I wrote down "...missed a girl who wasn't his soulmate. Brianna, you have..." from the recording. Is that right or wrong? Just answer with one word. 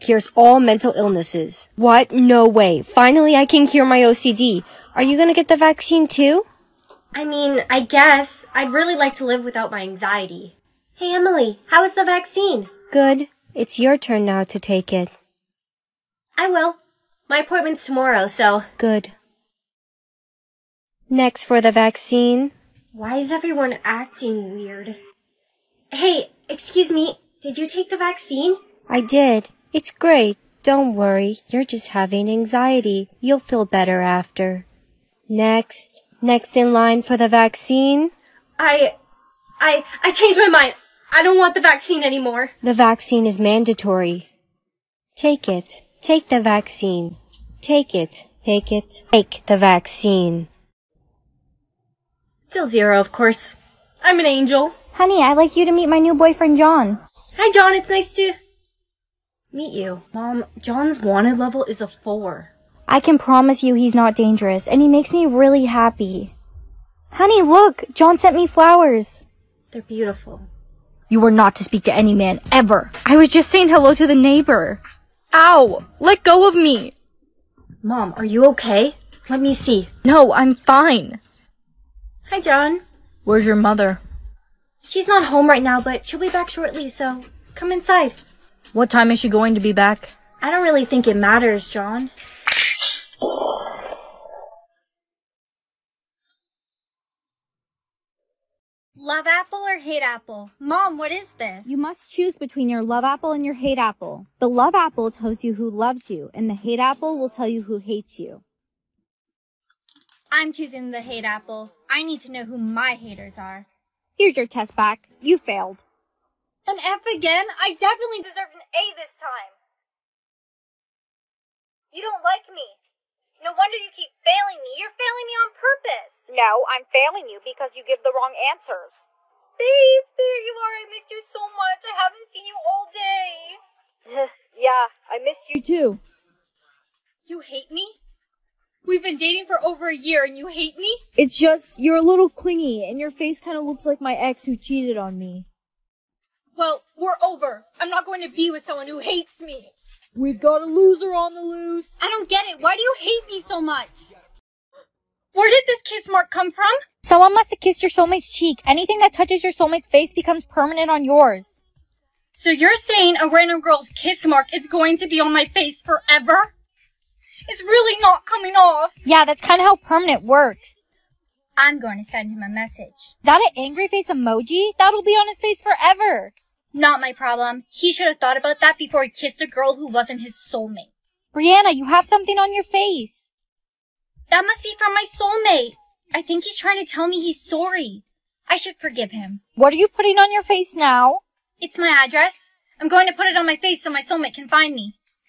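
wrong.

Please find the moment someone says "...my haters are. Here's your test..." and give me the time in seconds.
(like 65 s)
112 s.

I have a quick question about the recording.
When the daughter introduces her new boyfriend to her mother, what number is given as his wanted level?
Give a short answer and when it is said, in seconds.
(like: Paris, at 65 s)
4, at 61 s.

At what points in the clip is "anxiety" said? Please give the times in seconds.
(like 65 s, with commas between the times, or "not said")
9 s, 32 s.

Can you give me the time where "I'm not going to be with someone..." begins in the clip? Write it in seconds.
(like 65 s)
147 s.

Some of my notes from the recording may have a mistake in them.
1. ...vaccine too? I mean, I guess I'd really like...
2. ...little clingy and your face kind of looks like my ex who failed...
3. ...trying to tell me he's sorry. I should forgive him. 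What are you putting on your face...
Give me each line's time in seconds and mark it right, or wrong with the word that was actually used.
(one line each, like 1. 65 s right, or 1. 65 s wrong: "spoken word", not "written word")
1. 5 s right
2. 142 s wrong: "cheated", not "failed"
3. 186 s right.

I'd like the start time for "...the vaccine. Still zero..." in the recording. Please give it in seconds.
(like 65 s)
49 s.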